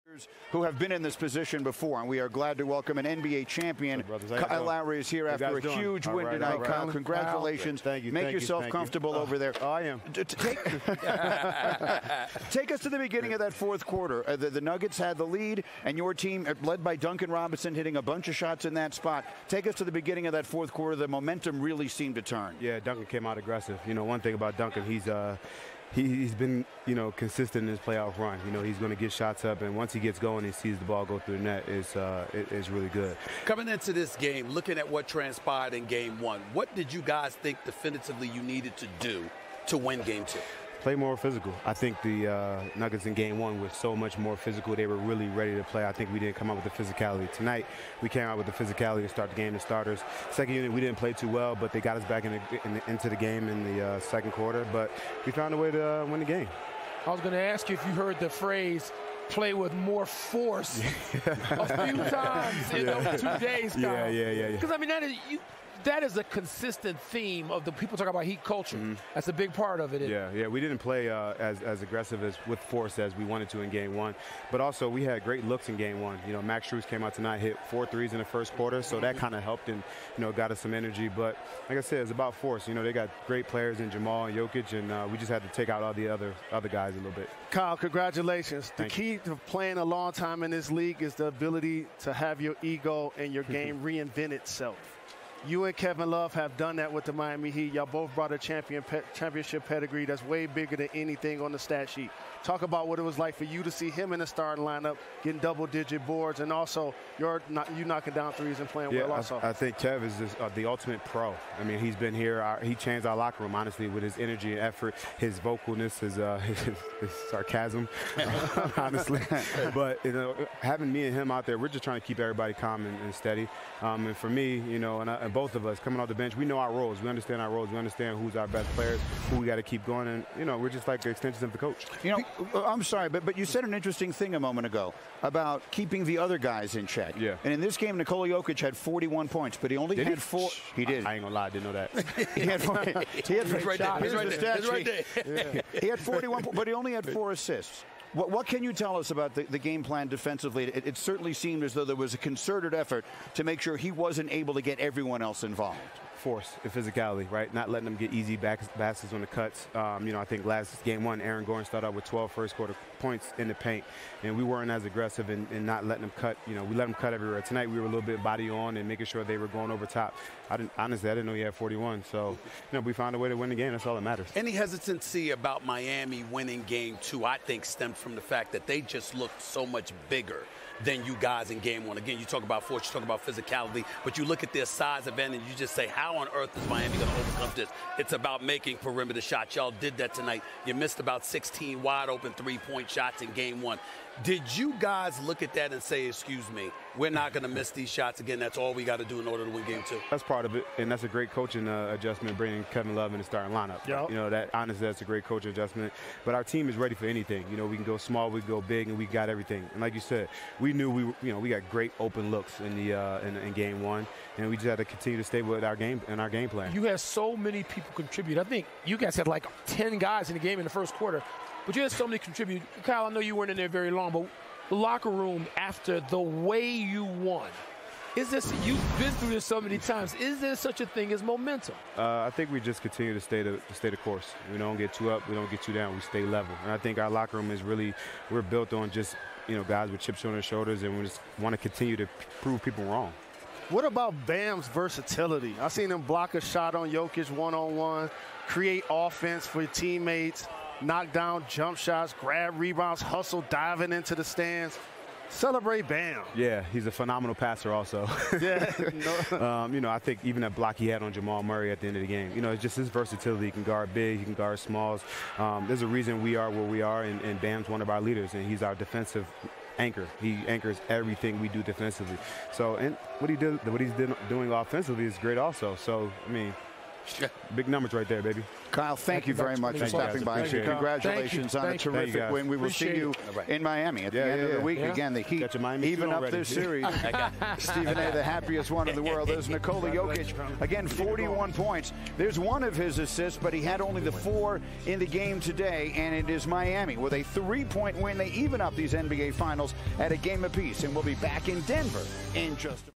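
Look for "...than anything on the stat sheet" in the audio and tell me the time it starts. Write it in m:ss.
1:40.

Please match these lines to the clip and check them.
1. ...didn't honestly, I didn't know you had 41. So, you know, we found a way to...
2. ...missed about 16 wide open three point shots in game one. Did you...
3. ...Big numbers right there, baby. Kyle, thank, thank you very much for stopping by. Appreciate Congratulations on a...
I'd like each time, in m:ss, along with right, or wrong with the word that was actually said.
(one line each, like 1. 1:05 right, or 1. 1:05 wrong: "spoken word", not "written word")
1. 2:50 right
2. 3:10 right
3. 4:37 right.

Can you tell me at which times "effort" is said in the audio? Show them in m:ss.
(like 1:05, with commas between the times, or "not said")
1:54, 2:32.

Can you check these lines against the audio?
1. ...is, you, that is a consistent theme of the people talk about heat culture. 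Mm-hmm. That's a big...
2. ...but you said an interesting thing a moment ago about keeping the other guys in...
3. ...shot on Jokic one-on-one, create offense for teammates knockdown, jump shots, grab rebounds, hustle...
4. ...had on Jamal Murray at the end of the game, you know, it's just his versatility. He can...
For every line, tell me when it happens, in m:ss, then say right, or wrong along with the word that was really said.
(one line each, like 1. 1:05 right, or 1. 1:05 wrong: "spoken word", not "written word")
1. 1:05 right
2. 2:13 right
3. 4:06 right
4. 4:20 right.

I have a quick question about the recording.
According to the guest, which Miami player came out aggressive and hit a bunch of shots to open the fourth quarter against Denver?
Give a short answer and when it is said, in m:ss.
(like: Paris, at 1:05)
Duncan Robinson, at 0:16.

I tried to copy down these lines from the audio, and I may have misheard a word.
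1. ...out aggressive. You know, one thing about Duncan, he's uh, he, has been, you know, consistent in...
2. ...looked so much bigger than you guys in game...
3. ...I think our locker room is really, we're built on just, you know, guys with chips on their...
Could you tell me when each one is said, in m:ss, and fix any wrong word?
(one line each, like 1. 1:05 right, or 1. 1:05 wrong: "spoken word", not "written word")
1. 0:23 right
2. 2:59 right
3. 3:56 right.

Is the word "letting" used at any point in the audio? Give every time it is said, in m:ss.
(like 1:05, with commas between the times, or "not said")
2:37, 2:45.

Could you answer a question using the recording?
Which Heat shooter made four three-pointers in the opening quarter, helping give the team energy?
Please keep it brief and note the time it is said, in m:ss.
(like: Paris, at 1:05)
Max Strus, at 1:16.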